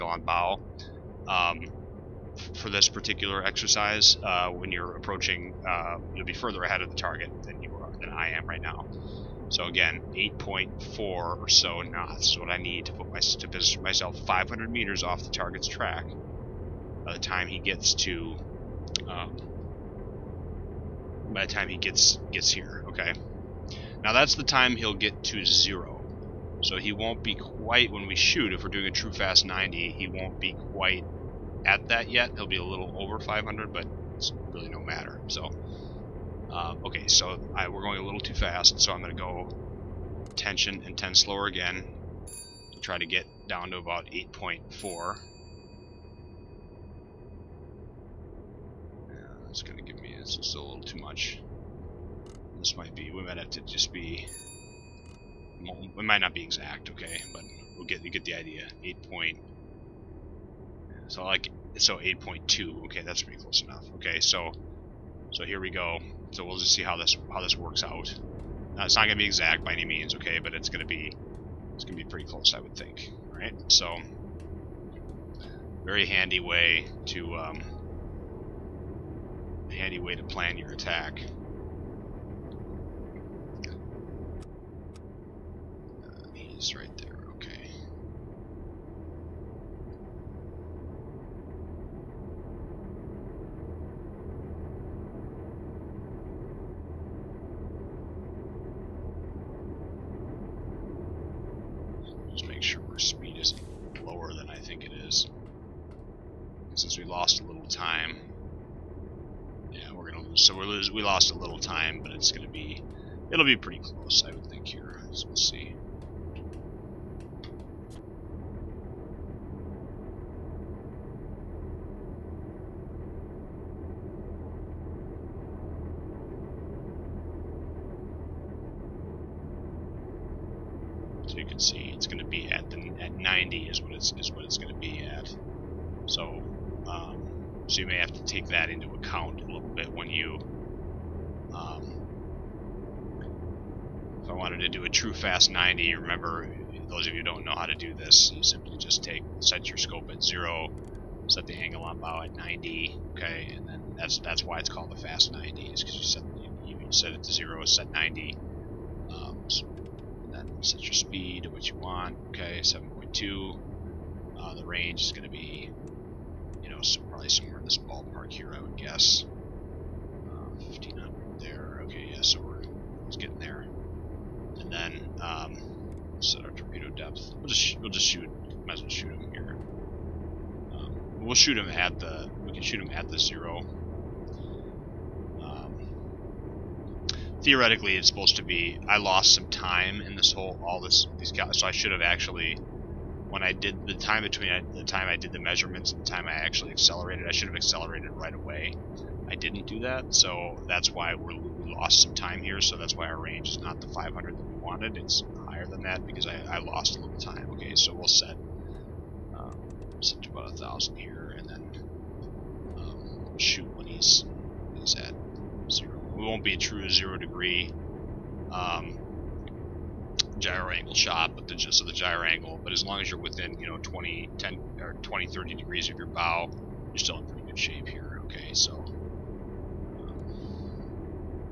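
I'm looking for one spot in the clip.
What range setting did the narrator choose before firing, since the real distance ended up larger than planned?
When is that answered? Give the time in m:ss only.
3:30.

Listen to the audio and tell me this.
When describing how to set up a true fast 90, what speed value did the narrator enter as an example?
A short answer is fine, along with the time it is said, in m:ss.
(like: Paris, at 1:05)
7.2, at 2:42.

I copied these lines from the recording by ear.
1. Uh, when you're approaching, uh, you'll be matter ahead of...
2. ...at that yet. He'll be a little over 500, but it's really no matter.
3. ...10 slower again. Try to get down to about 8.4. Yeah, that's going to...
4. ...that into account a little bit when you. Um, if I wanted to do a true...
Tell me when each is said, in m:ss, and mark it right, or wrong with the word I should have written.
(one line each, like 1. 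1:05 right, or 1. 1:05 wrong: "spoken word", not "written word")
1. 0:04 wrong: "further", not "matter"
2. 0:31 right
3. 0:40 right
4. 2:18 right.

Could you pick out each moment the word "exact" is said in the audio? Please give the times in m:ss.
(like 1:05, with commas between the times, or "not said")
0:56, 1:09.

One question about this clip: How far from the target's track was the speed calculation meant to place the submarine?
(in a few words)
500 meters.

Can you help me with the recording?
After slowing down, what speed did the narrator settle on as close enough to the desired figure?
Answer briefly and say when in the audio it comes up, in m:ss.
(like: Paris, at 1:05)
8.2, at 1:01.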